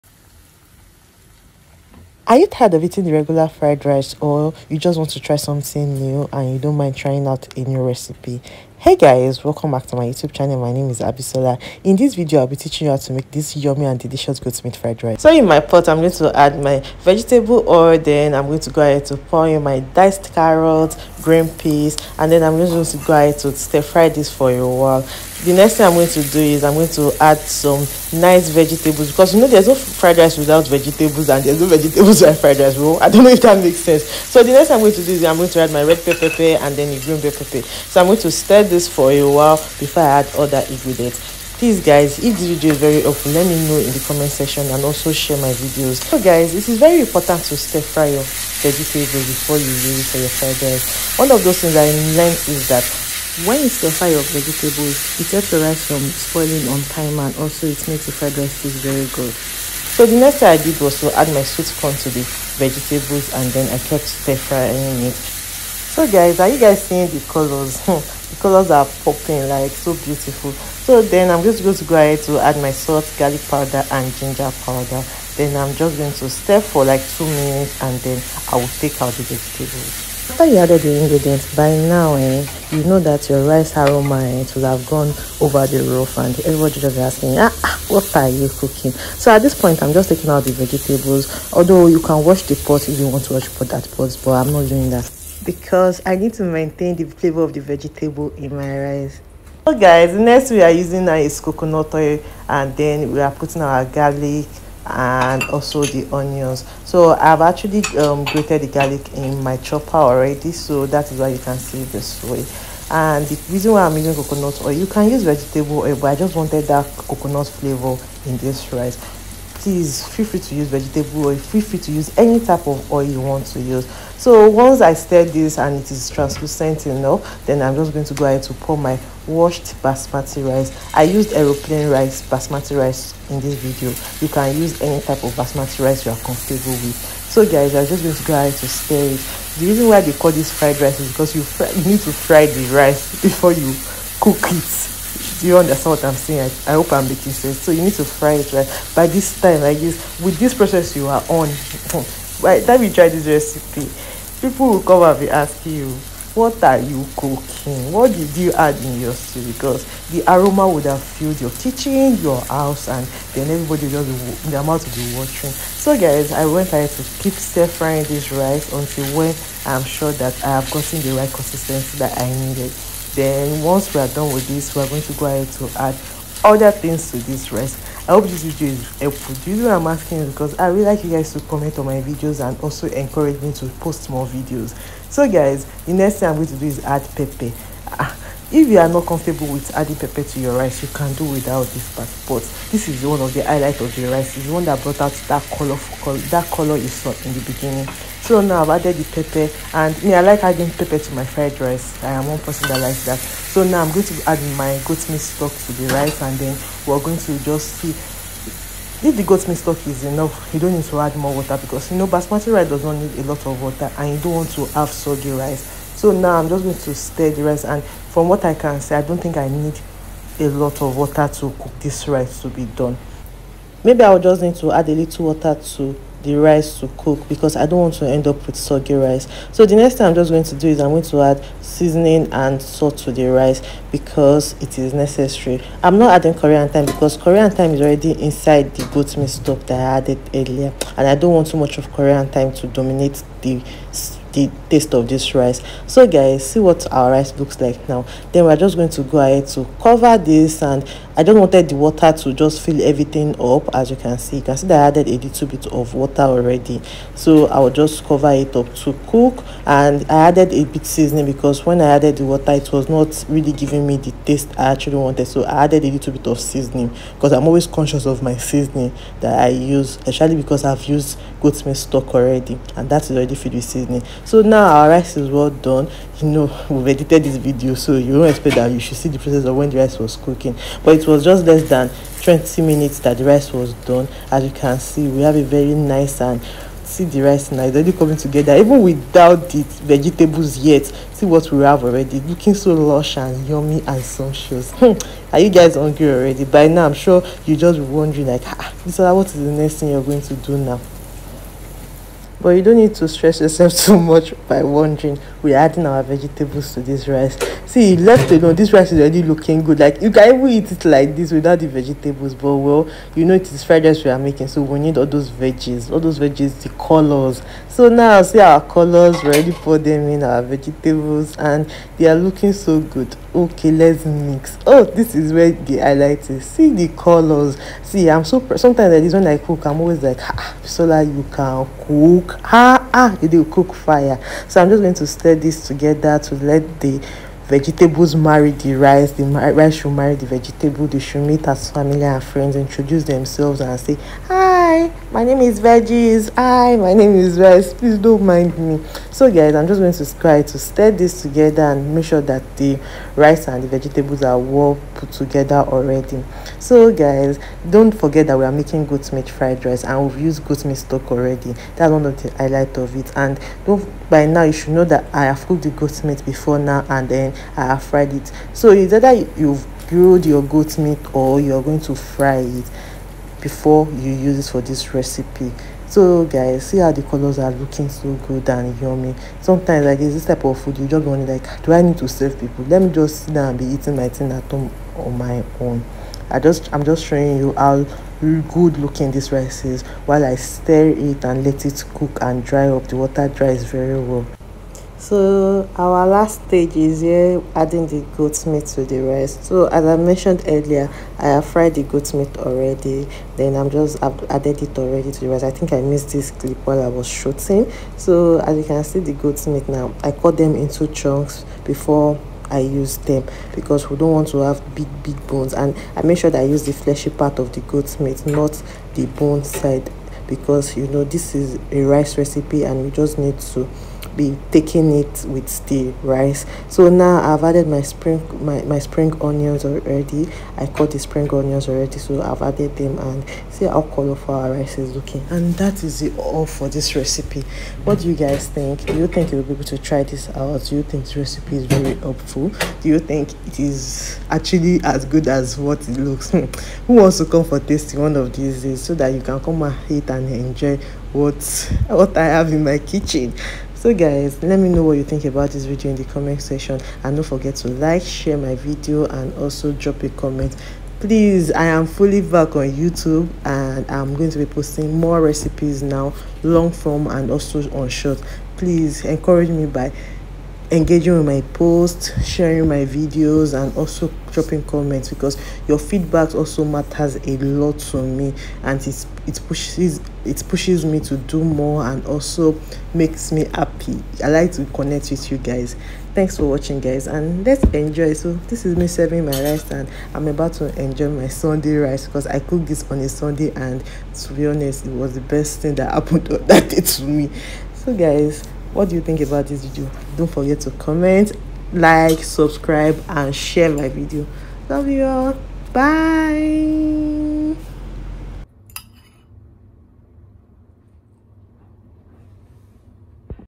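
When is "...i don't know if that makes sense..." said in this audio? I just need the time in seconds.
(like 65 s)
33 s.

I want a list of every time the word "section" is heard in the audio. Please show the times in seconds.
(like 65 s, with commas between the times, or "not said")
44 s, 456 s.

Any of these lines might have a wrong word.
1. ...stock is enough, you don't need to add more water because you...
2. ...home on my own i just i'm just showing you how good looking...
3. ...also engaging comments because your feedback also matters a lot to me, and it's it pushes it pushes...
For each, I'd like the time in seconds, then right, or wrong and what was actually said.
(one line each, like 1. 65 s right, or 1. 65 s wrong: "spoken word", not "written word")
1. 209 s right
2. 384 s right
3. 473 s wrong: "dropping", not "engaging".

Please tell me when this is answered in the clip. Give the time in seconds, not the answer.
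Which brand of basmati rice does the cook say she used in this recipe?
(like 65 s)
131 s.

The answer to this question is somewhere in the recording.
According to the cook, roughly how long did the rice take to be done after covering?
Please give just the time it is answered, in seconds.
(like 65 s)
281 s.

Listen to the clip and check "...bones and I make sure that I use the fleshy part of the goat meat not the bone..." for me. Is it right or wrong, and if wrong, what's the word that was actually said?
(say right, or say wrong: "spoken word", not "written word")
right.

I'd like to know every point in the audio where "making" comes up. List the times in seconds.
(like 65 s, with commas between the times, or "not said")
147 s, 314 s, 358 s.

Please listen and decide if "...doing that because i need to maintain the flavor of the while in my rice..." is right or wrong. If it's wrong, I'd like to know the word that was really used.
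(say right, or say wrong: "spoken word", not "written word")
wrong: "vegetable", not "while".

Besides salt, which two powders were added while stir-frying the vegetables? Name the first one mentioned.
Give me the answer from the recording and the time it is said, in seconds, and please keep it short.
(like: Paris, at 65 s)
Garlic powder, at 73 s.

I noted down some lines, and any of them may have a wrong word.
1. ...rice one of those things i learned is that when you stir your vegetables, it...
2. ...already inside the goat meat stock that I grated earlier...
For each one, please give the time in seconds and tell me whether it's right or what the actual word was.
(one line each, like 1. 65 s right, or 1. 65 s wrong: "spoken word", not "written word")
1. 50 s right
2. 237 s wrong: "added", not "grated".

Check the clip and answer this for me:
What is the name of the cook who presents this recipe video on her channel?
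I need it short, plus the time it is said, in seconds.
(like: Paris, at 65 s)
Abisola, at 11 s.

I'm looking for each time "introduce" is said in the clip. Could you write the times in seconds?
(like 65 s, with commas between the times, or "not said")
342 s.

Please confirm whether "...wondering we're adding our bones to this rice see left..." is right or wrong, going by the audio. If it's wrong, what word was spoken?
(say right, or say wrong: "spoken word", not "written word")
wrong: "vegetables", not "bones".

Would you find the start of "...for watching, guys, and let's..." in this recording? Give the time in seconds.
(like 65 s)
486 s.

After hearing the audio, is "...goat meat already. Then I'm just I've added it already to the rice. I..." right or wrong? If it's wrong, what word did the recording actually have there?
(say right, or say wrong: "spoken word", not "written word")
right.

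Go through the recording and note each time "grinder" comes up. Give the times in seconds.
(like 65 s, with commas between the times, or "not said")
not said.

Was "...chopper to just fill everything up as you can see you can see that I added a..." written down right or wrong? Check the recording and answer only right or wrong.
wrong.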